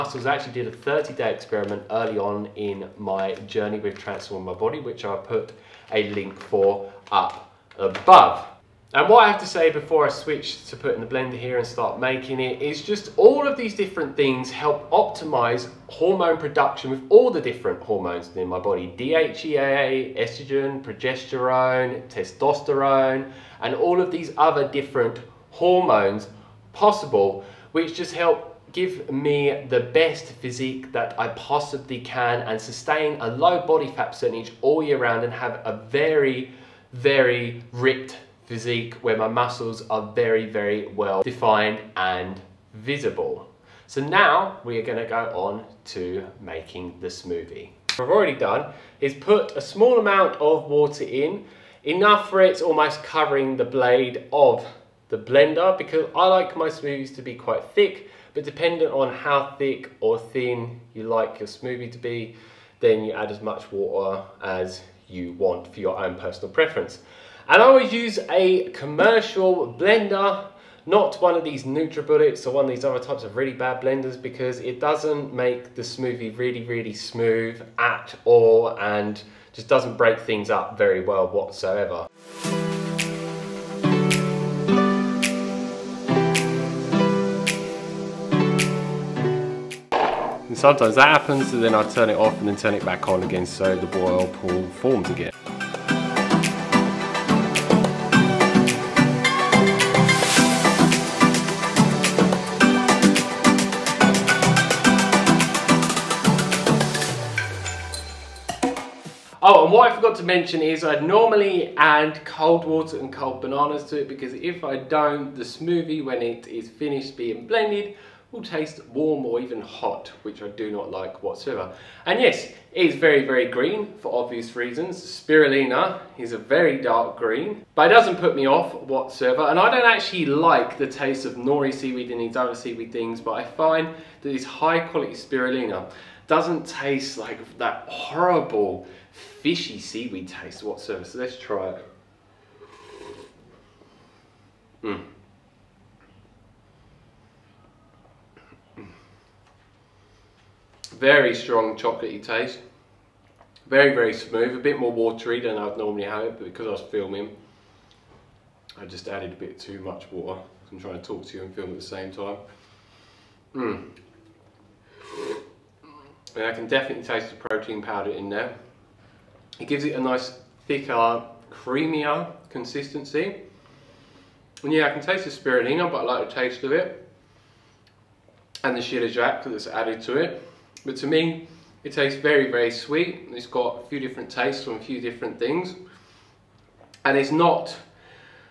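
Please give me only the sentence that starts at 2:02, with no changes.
And yes, it is very, very green for obvious reasons.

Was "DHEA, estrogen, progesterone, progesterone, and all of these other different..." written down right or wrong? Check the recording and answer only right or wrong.
wrong.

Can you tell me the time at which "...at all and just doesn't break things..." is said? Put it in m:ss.
1:17.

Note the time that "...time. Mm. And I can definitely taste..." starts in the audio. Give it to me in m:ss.
2:42.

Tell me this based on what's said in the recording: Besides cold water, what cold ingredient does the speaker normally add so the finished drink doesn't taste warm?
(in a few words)
Cold bananas.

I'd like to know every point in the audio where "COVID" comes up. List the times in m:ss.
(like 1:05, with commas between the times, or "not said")
not said.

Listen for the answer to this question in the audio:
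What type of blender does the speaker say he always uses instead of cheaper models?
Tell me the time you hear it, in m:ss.
1:08.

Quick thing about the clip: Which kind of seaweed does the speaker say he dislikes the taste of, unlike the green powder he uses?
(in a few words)
Nori.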